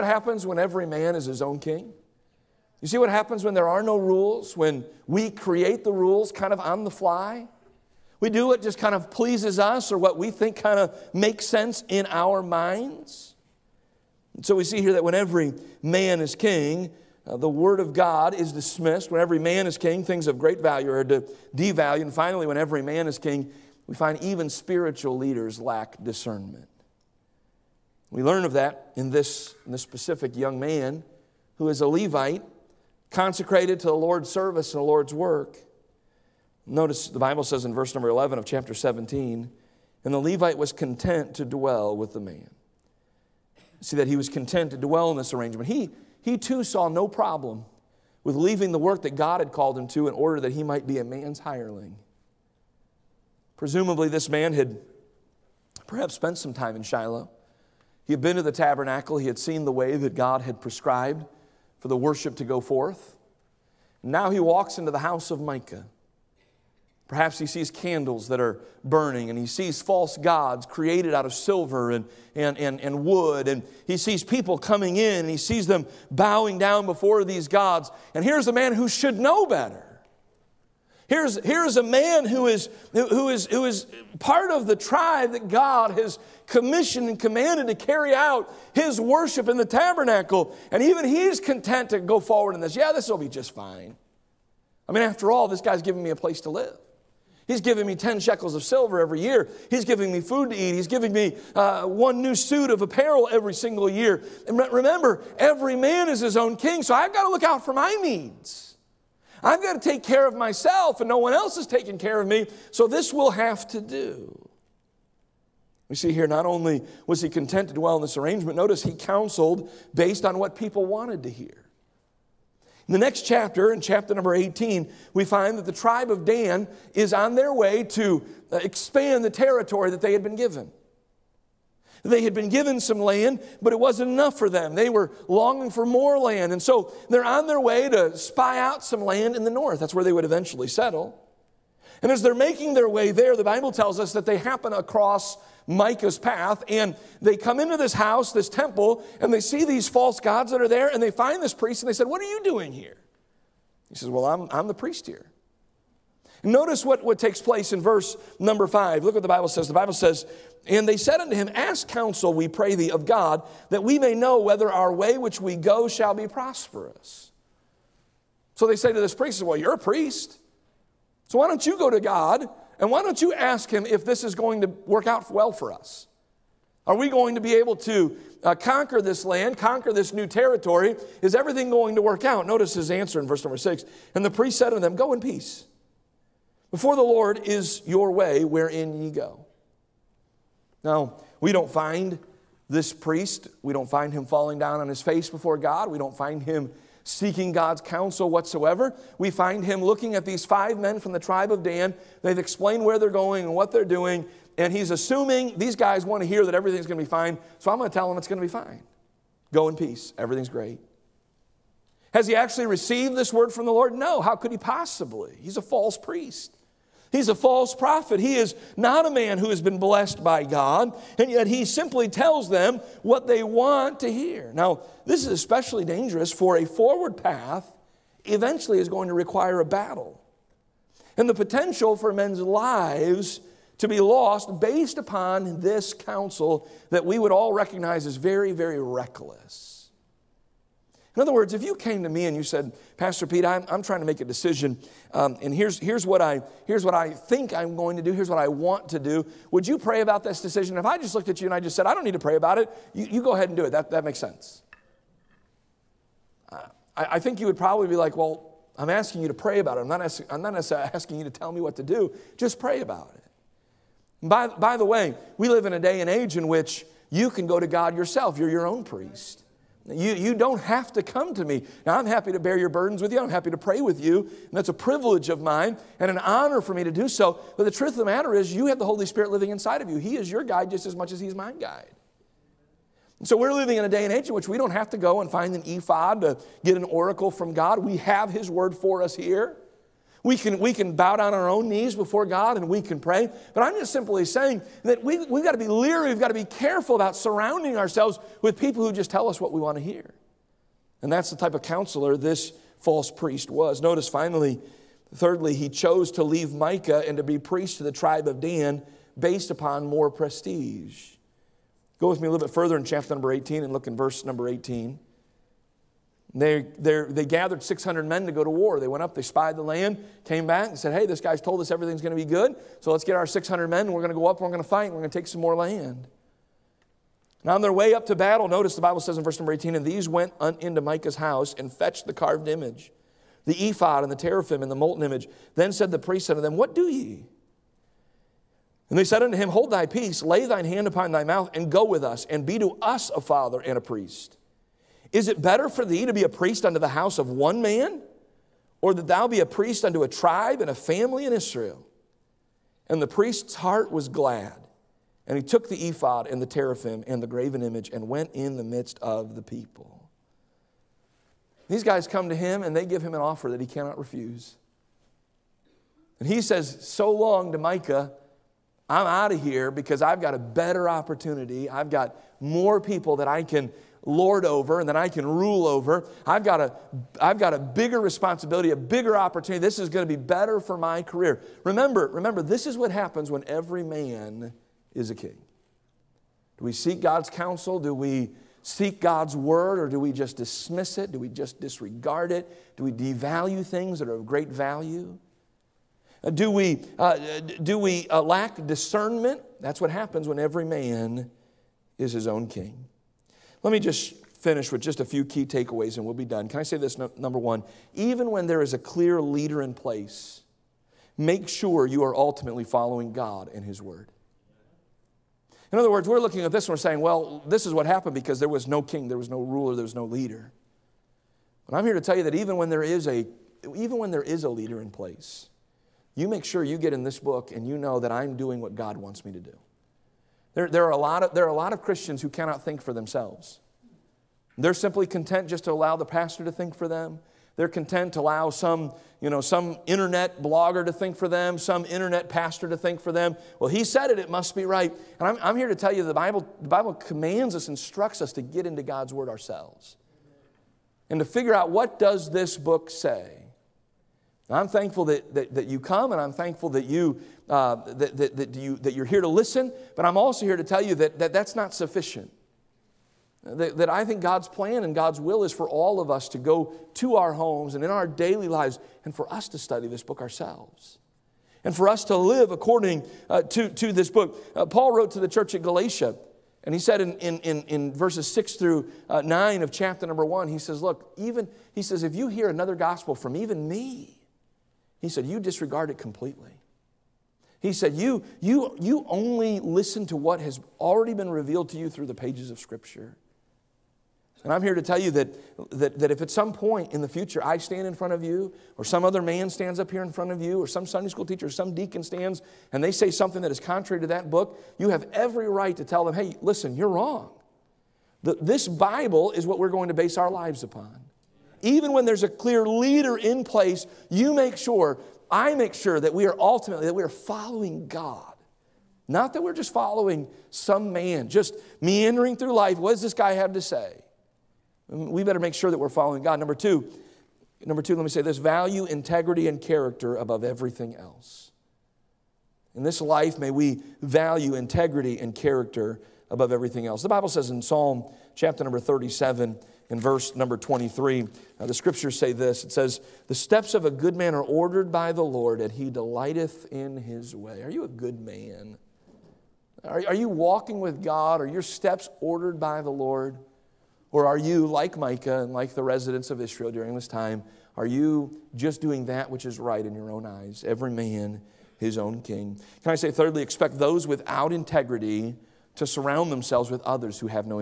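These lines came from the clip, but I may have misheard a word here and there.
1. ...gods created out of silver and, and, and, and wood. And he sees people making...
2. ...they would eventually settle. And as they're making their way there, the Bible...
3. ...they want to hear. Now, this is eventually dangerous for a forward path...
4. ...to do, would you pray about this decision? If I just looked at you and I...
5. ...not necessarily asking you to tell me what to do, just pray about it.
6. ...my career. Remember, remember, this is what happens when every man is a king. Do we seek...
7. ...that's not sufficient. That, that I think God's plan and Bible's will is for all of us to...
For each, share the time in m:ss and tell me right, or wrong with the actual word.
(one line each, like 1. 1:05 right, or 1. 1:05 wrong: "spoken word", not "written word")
1. 1:10 wrong: "coming", not "making"
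2. 2:20 right
3. 3:43 wrong: "especially", not "eventually"
4. 4:08 right
5. 4:20 right
6. 6:20 right
7. 7:41 wrong: "God", not "Bible".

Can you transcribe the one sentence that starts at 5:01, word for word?
And that's the type of counselor this false priest was.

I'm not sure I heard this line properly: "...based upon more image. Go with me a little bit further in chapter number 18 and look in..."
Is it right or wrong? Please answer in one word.
wrong.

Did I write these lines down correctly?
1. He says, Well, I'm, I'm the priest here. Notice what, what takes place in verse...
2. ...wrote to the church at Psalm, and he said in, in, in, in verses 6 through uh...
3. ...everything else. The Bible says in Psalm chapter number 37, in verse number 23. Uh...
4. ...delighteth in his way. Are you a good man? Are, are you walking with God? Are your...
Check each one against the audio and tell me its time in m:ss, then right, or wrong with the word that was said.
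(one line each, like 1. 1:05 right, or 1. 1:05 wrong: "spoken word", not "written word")
1. 2:33 right
2. 7:54 wrong: "Galatia", not "Psalm"
3. 8:56 right
4. 9:05 right.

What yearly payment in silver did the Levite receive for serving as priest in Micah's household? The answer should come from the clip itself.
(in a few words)
10 shekels.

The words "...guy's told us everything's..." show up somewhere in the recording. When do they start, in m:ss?
5:21.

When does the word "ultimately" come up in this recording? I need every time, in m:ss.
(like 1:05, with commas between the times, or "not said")
6:52, 8:36.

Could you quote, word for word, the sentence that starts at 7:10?
There, there, are a lot of, there are a lot of Christians who cannot think for themselves.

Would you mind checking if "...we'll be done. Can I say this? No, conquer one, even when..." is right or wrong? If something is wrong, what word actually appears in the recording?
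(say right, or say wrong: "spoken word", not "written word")
wrong: "number", not "conquer".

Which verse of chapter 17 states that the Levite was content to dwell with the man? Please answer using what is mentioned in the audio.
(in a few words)
Verse 11.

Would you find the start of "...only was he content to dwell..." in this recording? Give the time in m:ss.
1:56.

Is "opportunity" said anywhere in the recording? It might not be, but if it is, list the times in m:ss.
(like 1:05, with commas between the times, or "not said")
6:10, 6:19.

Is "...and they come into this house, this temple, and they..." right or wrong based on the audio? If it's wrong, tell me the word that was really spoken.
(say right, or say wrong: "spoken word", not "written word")
right.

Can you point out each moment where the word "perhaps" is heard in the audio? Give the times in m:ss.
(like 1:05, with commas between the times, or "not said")
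0:55, 1:07.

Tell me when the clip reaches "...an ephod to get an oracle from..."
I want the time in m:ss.
4:45.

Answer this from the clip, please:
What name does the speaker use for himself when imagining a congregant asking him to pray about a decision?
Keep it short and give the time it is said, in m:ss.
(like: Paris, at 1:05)
Pastor Pete, at 4:02.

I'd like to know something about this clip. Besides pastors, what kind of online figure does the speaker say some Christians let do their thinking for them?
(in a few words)
internet blogger.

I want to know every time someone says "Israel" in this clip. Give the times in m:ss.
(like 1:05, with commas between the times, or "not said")
5:51, 9:16.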